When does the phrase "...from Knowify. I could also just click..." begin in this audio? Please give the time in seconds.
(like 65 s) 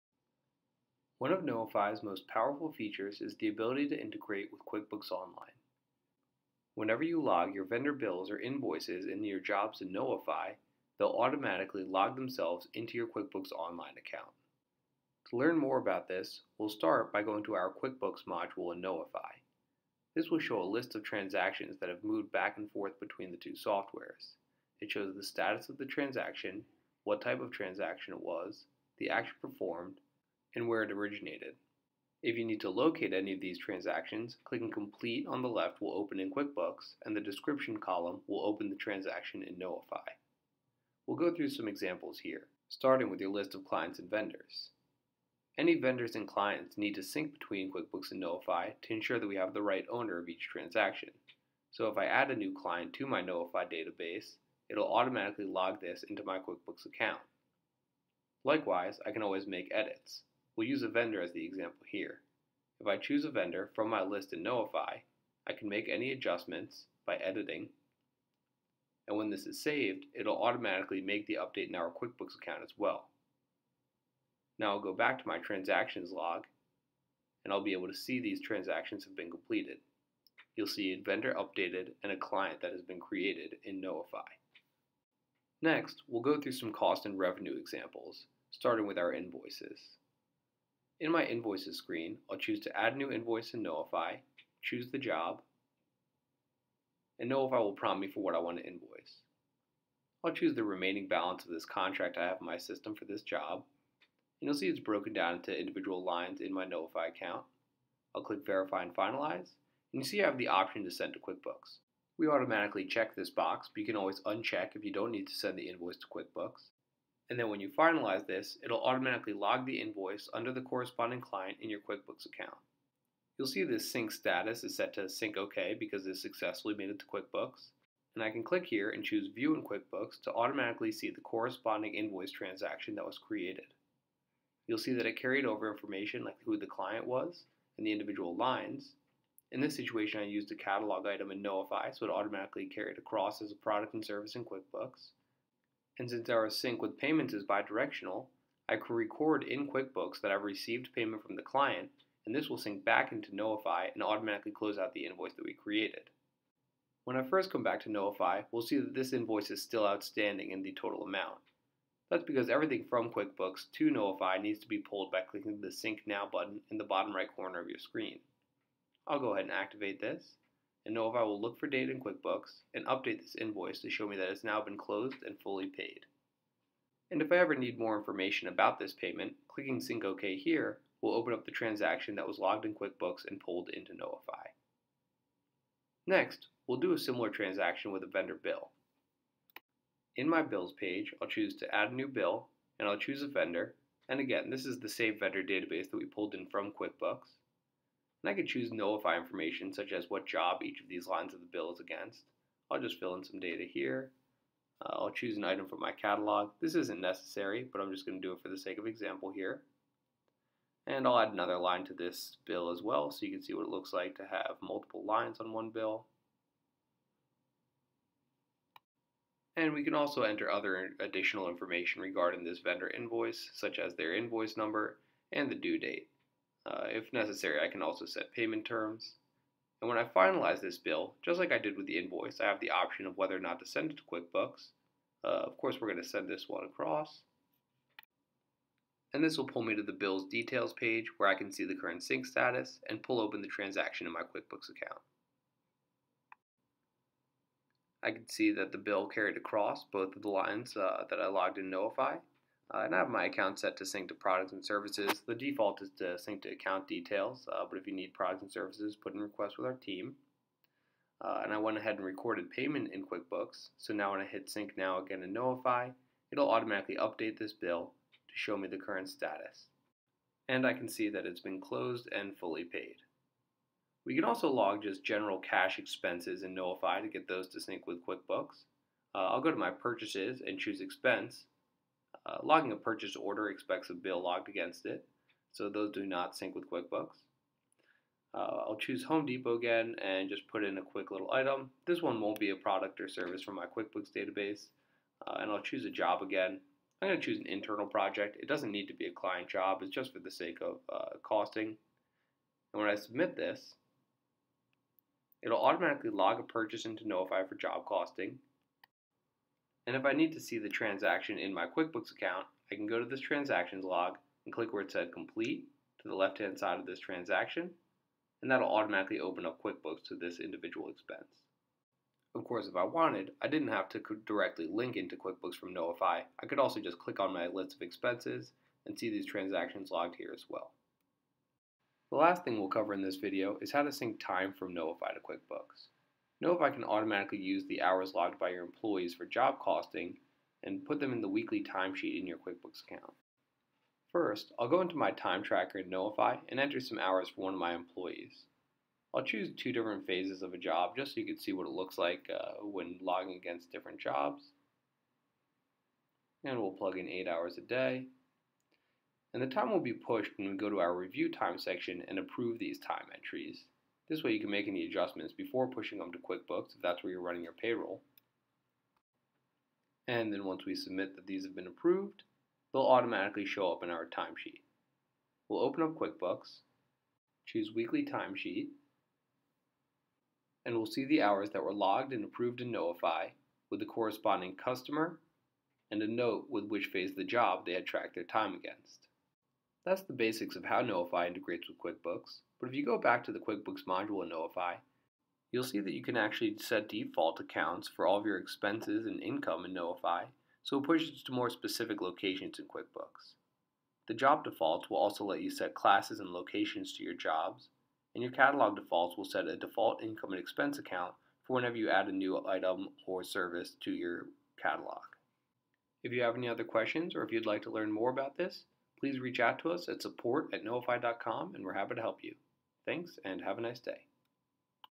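325 s.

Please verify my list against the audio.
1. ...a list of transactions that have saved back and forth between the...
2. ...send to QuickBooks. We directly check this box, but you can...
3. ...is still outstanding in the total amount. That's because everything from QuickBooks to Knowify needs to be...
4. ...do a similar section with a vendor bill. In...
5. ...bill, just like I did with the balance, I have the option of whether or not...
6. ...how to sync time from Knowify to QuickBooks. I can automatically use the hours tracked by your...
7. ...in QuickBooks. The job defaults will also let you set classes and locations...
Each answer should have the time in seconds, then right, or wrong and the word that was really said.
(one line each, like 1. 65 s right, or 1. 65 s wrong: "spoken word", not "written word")
1. 20 s wrong: "moved", not "saved"
2. 110 s wrong: "automatically", not "directly"
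3. 159 s right
4. 186 s wrong: "transaction", not "section"
5. 230 s wrong: "invoice", not "balance"
6. 333 s wrong: "logged", not "tracked"
7. 402 s right.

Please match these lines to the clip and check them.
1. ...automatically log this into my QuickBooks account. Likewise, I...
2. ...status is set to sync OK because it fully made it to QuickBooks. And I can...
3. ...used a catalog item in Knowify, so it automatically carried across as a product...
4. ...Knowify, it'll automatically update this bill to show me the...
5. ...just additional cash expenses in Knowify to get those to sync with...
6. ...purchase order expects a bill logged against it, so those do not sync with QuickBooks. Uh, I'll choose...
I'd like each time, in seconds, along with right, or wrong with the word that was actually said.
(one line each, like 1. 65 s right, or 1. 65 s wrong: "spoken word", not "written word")
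1. 54 s right
2. 124 s wrong: "successfully", not "fully"
3. 140 s right
4. 265 s right
5. 274 s wrong: "general", not "additional"
6. 282 s right.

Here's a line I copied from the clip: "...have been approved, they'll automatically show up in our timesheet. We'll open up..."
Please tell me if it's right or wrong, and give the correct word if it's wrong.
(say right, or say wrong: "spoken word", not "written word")
right.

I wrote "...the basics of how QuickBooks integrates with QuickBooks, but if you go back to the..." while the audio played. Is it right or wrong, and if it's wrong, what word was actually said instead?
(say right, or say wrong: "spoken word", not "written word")
wrong: "Knowify", not "QuickBooks".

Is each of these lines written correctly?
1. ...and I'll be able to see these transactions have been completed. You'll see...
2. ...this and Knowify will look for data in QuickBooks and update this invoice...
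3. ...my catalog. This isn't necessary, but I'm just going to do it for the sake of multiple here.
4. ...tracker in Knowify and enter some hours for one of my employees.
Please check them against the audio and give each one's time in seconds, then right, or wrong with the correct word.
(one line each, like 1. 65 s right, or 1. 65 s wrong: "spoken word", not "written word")
1. 77 s right
2. 170 s right
3. 205 s wrong: "example", not "multiple"
4. 345 s right.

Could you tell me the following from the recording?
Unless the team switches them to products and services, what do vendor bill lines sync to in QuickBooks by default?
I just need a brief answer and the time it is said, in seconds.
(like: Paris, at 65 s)
account details, at 256 s.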